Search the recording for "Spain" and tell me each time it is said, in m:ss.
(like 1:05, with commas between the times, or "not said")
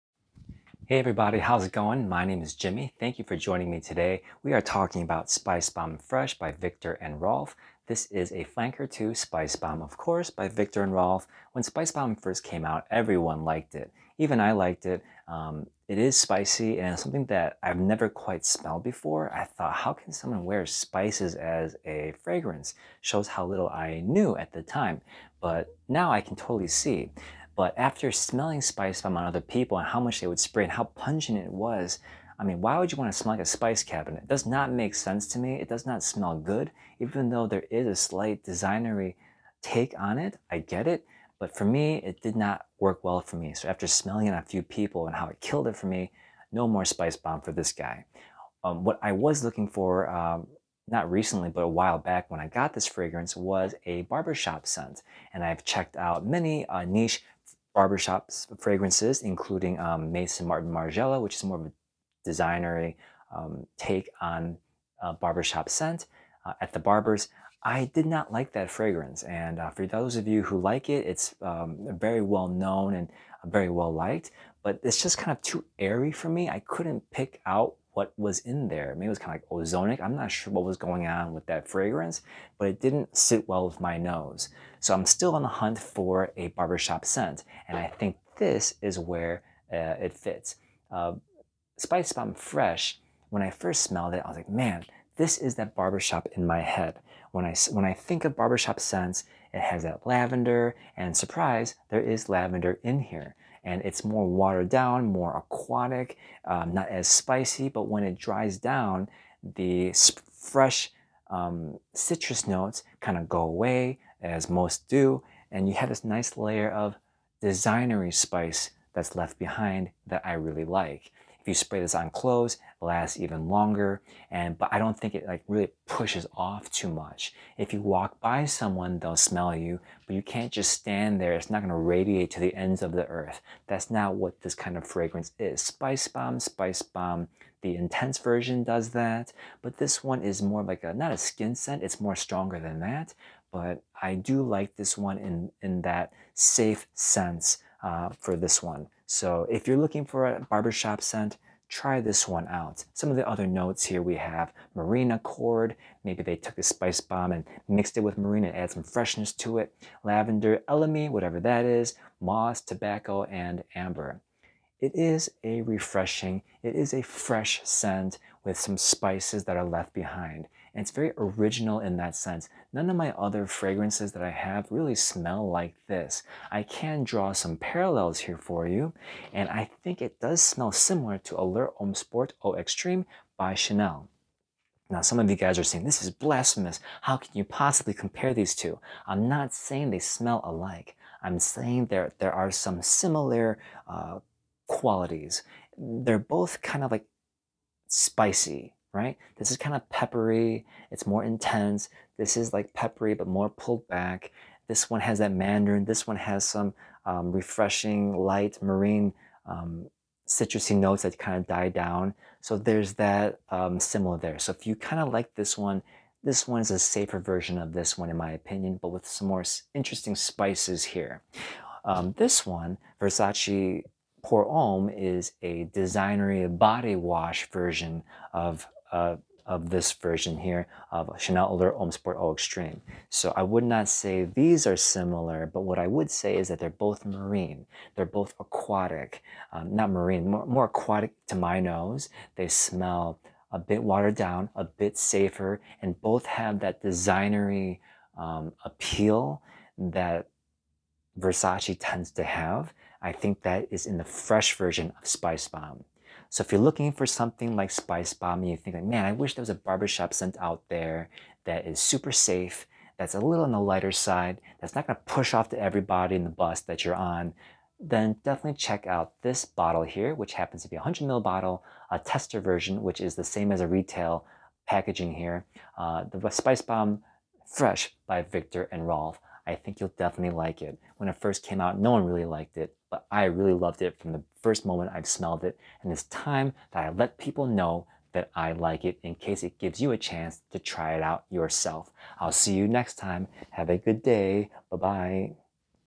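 not said.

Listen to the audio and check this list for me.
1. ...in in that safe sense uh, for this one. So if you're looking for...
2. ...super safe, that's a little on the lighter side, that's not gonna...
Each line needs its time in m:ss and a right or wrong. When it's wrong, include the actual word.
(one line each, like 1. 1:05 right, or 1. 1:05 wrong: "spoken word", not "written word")
1. 2:25 right
2. 4:21 right.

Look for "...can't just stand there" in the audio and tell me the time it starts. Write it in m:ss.
2:10.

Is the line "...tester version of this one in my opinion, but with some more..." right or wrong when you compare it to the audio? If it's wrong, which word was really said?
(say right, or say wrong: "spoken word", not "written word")
wrong: "safer", not "tester".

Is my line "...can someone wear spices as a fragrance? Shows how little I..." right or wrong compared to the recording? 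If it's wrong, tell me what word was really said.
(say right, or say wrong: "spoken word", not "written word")
right.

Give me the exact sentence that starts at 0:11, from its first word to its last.
When Spice Bomb first came out, everyone liked it.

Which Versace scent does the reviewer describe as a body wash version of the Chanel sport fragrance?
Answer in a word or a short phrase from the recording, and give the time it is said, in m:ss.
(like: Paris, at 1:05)
Versace Pour Homme, at 3:43.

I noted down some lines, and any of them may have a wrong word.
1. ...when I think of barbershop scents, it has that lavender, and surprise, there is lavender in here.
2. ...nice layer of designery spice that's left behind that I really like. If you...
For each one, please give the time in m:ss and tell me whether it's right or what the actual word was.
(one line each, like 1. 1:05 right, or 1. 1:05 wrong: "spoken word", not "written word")
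1. 1:37 right
2. 1:56 right.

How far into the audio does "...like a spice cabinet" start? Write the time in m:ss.
0:33.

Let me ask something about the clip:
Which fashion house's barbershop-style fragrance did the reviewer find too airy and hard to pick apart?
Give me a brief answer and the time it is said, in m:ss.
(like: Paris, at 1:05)
Maison Martin Margiela, at 1:00.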